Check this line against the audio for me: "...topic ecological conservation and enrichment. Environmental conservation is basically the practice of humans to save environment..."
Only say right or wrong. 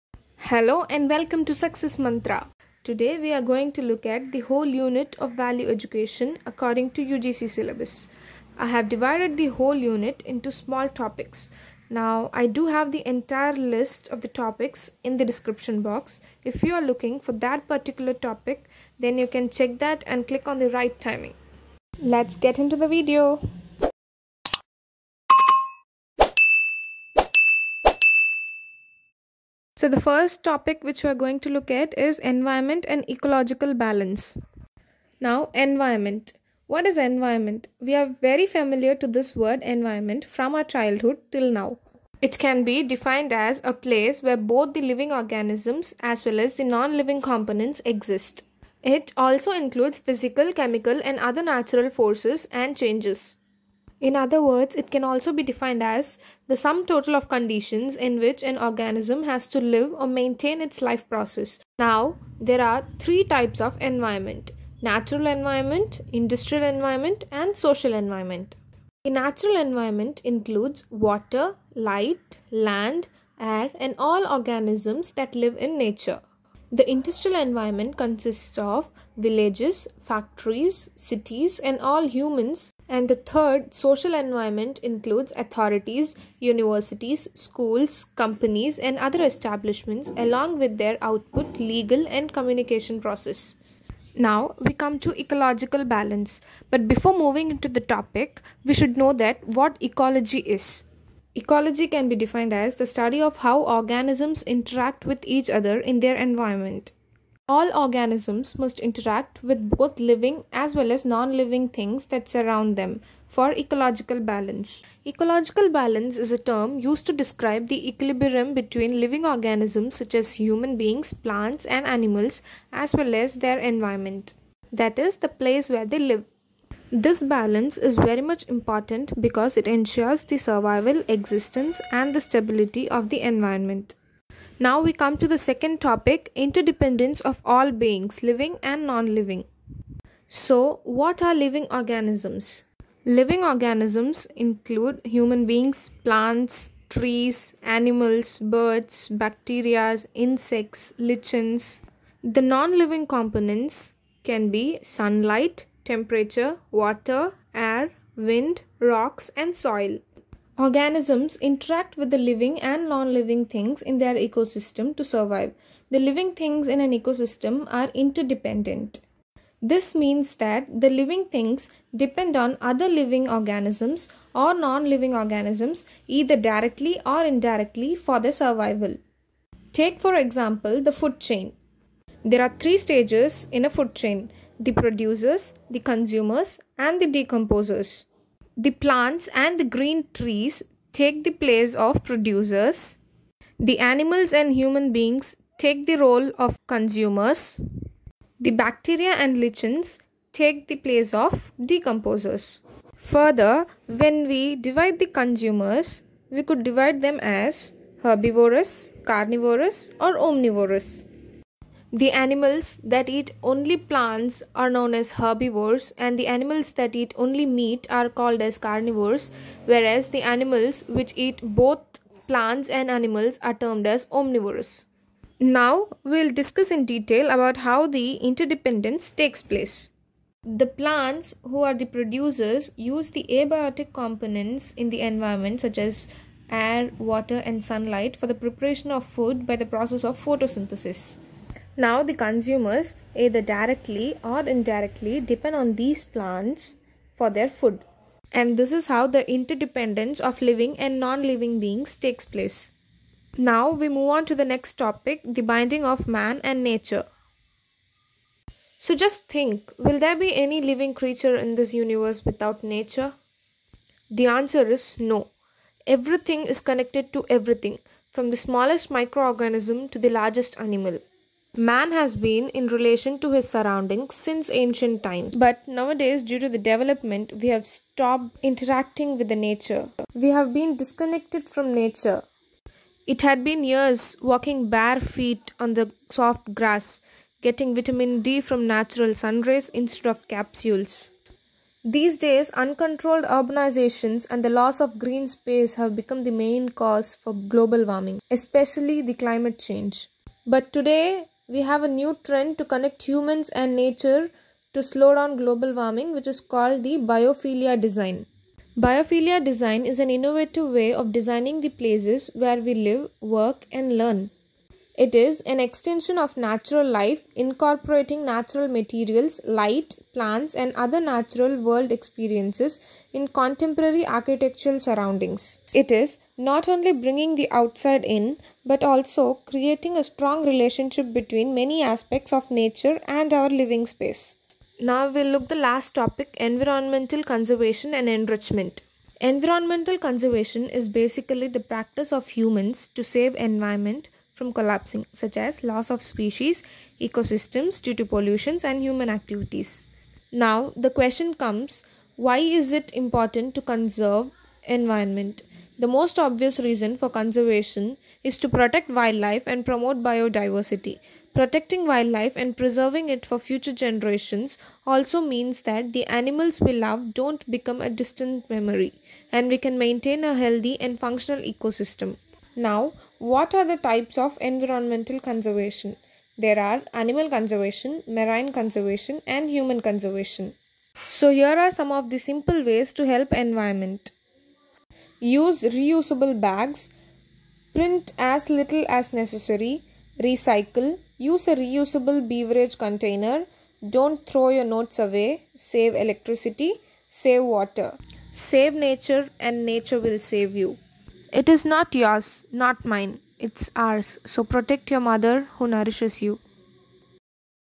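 wrong.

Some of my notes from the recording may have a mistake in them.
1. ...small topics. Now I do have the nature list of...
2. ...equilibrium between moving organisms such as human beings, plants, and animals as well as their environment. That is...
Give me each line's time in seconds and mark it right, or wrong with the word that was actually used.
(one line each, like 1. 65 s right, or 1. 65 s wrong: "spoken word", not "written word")
1. 10 s wrong: "entire", not "nature"
2. 117 s wrong: "living", not "moving".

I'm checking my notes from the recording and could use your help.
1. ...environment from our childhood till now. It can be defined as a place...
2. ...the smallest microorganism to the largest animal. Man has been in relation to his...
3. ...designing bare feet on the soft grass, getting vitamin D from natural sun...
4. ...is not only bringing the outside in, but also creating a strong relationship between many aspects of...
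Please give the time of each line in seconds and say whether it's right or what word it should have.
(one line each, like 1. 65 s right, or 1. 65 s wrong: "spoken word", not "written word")
1. 39 s right
2. 268 s right
3. 284 s wrong: "walking", not "designing"
4. 325 s right.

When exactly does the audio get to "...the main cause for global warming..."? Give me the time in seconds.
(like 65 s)
296 s.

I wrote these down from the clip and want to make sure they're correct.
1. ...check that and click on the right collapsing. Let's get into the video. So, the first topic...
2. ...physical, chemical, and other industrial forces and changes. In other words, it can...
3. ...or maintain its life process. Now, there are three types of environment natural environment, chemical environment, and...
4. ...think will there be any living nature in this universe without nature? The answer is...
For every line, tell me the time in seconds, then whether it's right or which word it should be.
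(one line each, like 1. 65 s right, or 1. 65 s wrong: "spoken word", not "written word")
1. 19 s wrong: "timing", not "collapsing"
2. 49 s wrong: "natural", not "industrial"
3. 59 s wrong: "industrial", not "chemical"
4. 259 s wrong: "creature", not "nature".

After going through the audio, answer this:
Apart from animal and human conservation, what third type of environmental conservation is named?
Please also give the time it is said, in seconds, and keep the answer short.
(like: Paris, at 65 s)
Marine conservation, at 378 s.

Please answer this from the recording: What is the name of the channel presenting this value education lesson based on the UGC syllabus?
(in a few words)
Success Mantra.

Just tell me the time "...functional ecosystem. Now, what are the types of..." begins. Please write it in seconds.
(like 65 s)
370 s.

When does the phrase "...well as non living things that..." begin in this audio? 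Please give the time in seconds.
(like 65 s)
110 s.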